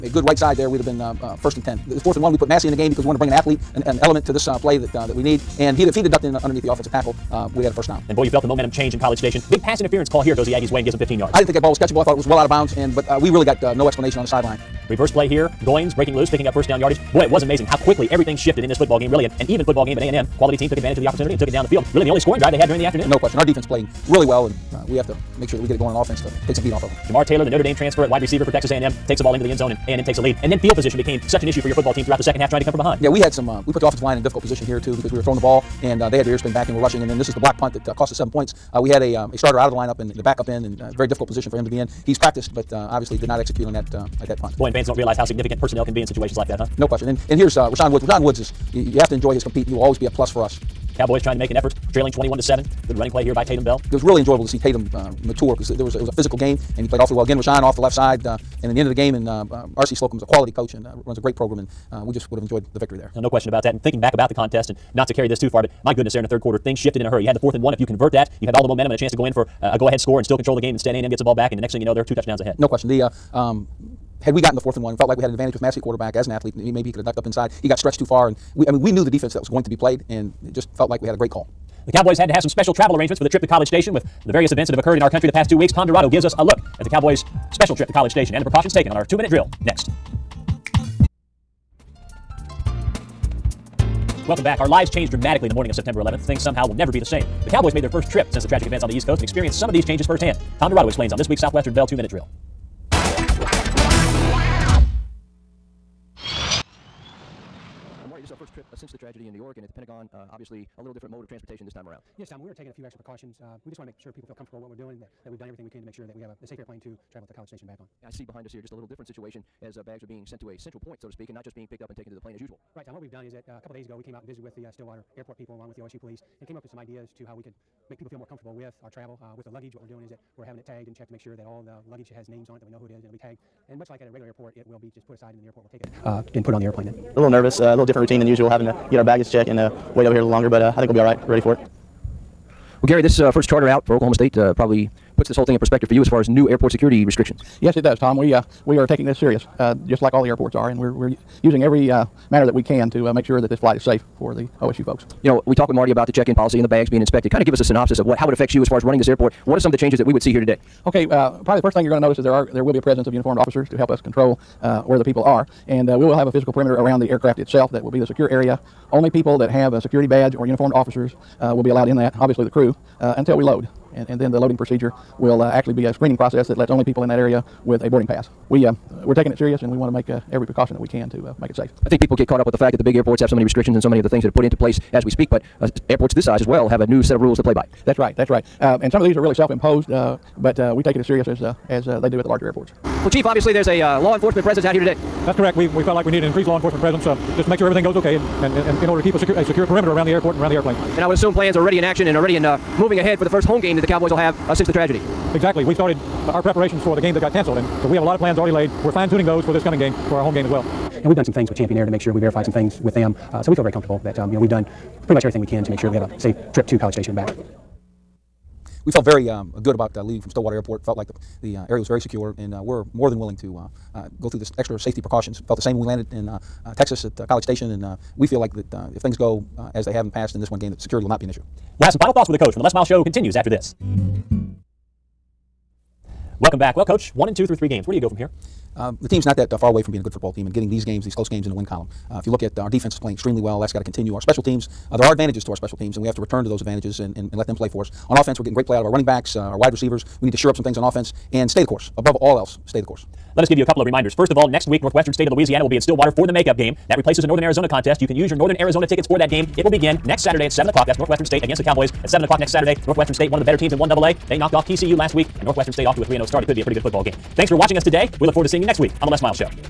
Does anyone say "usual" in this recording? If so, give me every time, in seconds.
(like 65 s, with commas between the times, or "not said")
122 s, 138 s.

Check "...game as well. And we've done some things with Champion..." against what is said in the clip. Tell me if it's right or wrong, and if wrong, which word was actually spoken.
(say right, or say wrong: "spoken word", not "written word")
right.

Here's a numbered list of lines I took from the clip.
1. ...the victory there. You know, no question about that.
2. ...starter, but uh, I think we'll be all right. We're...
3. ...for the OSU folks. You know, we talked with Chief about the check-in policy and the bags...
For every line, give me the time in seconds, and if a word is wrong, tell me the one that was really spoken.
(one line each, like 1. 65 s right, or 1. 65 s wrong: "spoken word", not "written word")
1. 62 s right
2. 140 s wrong: "longer", not "starter"
3. 154 s wrong: "Marty", not "Chief".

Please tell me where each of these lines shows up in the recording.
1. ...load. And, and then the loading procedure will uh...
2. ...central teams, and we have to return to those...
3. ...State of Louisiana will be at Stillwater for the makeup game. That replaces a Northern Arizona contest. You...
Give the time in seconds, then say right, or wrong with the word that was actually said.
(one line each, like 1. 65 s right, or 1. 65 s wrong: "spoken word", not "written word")
1. 173 s right
2. 245 s wrong: "special", not "central"
3. 255 s right.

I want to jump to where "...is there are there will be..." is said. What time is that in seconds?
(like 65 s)
162 s.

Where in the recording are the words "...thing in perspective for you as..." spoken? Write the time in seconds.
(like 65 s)
145 s.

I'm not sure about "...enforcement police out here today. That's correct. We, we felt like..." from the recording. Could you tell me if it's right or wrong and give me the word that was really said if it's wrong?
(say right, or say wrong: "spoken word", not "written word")
wrong: "presence", not "police".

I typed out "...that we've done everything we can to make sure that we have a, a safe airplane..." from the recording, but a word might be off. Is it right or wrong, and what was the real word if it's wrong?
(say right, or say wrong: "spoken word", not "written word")
right.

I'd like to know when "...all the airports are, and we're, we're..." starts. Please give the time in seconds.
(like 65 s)
150 s.